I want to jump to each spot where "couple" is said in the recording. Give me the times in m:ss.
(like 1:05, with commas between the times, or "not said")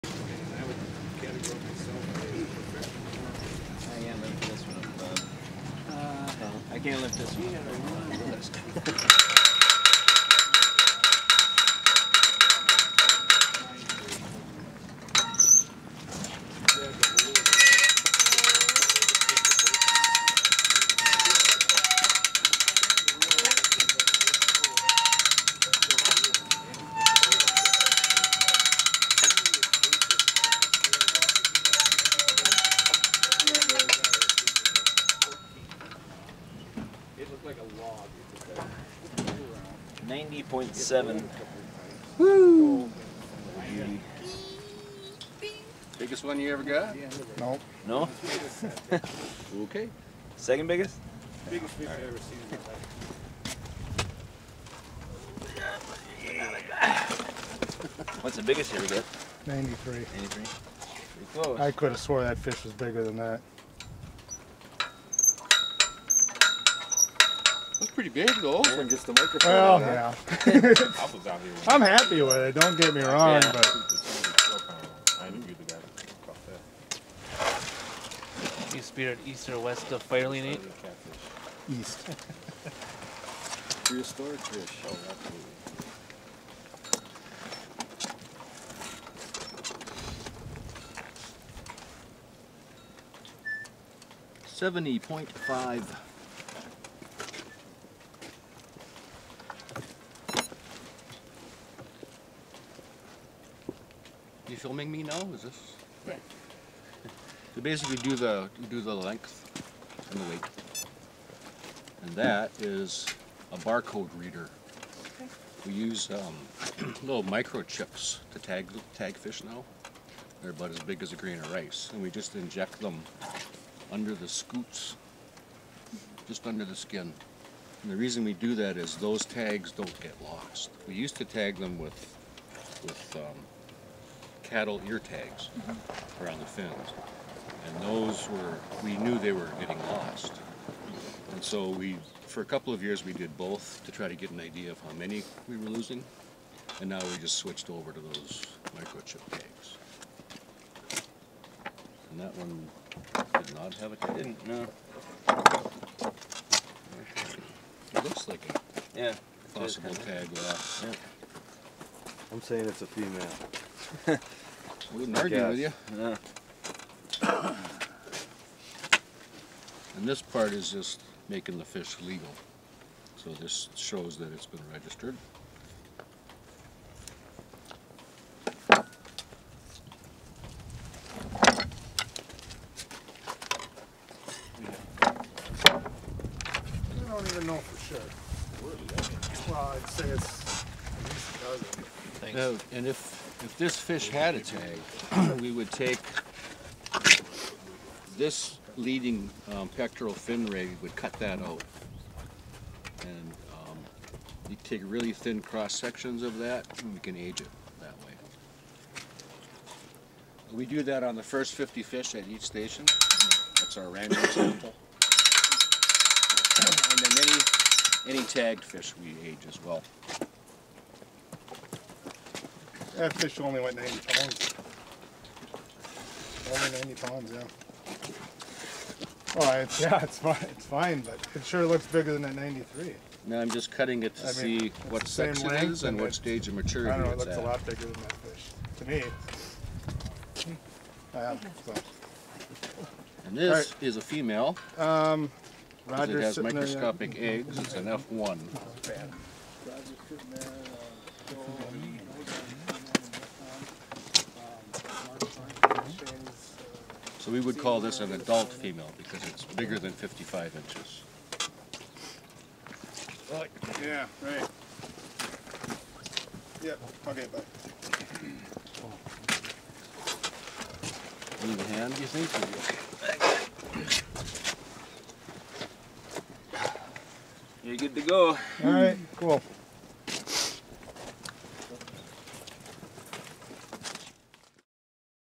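2:22.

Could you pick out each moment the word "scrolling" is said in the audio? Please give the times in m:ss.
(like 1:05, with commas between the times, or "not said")
not said.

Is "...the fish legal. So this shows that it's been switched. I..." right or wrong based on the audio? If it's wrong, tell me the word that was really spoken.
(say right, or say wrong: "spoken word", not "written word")
wrong: "registered", not "switched".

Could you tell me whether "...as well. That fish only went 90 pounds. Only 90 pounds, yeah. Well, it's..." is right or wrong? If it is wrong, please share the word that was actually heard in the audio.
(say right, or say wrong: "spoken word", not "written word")
right.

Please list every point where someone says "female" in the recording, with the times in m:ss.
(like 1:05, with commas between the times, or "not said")
2:42, 4:04, 4:18.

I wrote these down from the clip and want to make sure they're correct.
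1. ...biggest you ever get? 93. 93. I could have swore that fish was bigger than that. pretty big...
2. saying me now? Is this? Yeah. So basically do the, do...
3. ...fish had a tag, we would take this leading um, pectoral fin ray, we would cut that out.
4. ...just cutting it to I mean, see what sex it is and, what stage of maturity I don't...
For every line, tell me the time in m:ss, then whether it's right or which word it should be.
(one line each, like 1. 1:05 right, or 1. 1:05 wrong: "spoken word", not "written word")
1. 0:58 right
2. 1:44 wrong: "filming", not "saying"
3. 3:13 right
4. 3:53 right.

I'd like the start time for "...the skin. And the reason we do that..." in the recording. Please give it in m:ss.
2:06.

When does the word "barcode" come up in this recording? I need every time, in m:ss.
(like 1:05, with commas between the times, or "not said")
1:53.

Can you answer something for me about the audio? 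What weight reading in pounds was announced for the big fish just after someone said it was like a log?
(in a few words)
90.7.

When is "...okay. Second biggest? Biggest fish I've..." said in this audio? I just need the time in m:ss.
0:49.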